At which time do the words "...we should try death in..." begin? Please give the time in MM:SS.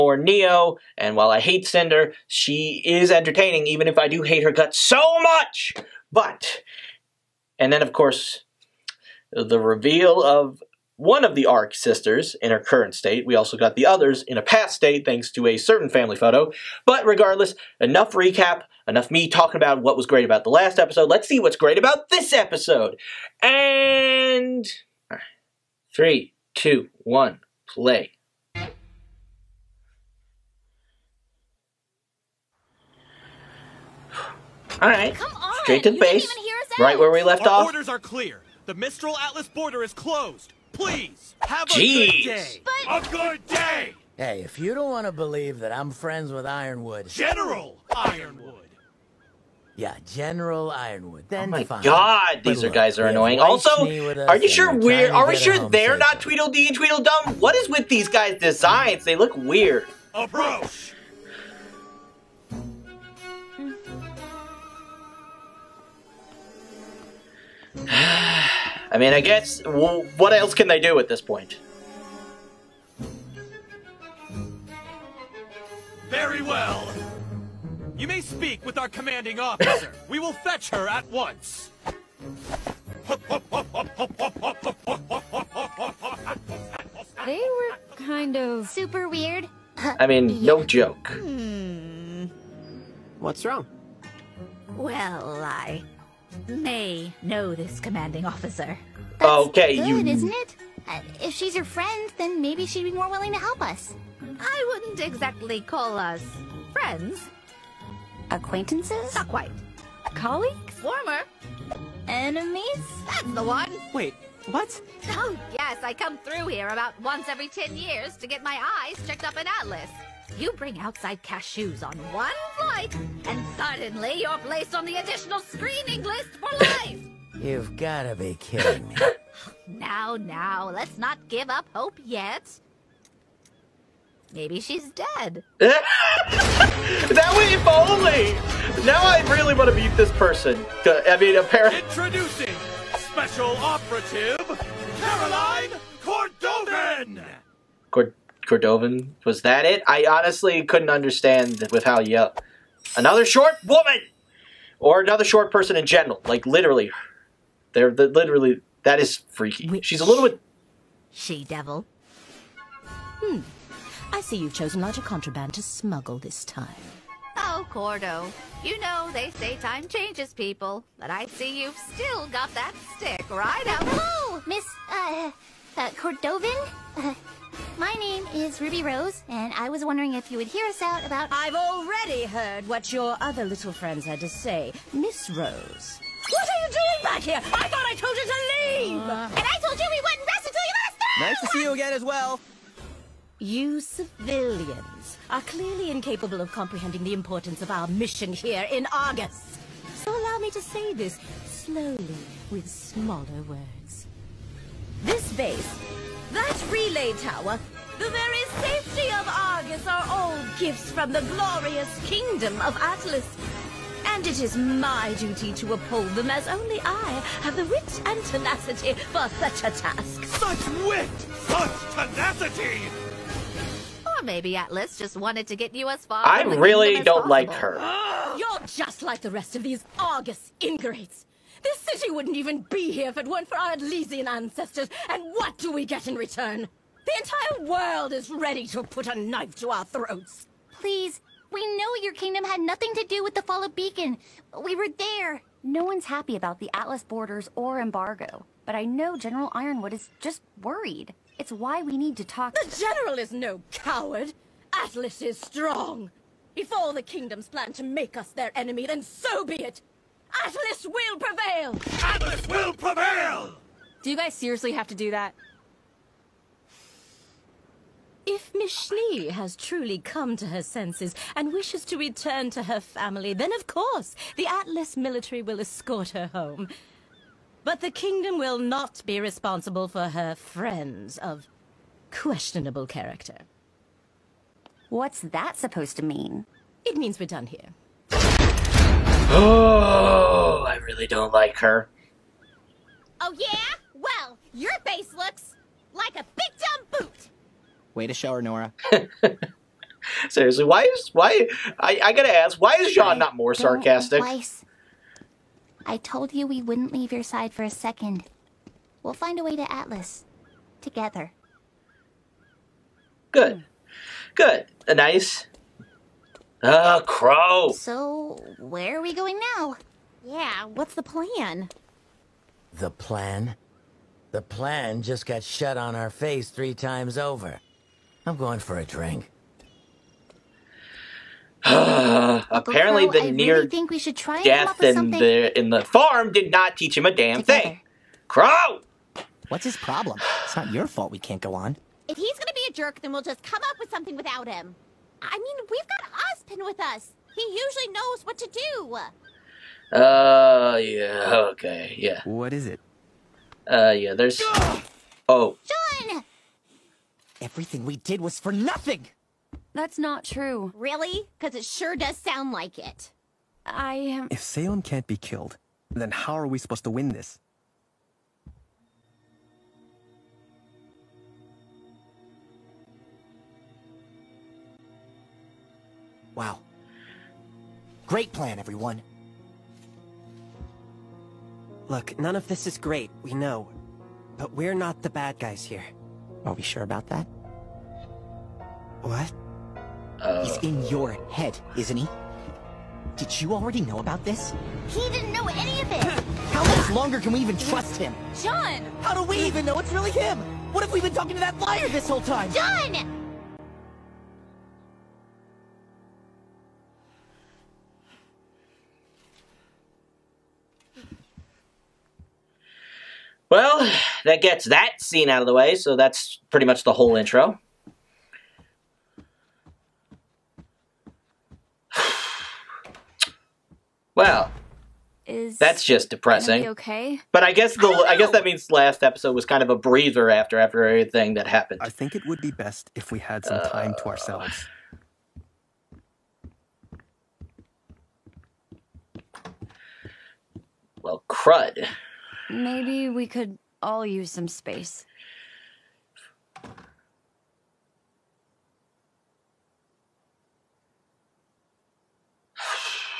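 05:33.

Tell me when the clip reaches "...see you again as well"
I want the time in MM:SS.
03:11.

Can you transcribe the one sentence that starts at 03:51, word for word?
This city wouldn't even be here if it weren't for our Atlesian ancestors.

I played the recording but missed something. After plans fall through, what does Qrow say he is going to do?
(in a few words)
for a drink.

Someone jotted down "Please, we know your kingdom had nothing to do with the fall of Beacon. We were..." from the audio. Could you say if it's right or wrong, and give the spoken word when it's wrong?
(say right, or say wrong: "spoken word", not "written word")
right.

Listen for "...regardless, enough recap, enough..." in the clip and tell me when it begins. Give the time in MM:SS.
00:17.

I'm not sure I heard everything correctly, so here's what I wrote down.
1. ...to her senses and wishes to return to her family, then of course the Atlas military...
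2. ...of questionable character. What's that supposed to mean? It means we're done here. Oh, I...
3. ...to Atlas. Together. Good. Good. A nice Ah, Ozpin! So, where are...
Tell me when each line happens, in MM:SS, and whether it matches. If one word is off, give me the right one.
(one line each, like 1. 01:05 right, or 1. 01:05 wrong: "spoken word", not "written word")
1. 04:30 right
2. 04:41 right
3. 05:09 wrong: "Qrow", not "Ozpin".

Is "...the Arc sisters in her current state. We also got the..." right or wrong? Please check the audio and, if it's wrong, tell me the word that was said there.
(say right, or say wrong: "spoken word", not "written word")
right.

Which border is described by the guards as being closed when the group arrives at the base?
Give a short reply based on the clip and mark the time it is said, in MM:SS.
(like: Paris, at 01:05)
Mistral Atlas border, at 00:38.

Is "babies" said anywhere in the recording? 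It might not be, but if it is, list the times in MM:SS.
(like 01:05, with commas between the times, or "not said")
not said.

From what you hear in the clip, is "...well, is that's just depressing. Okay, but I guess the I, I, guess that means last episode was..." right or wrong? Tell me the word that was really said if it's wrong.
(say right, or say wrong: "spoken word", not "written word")
right.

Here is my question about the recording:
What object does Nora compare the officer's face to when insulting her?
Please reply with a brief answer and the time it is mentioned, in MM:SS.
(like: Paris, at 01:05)
boot, at 04:57.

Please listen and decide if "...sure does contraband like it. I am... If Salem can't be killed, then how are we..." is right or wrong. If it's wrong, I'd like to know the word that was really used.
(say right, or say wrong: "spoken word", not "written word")
wrong: "sound", not "contraband".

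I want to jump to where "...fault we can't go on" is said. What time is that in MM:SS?
05:40.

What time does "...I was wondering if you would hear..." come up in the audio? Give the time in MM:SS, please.
02:59.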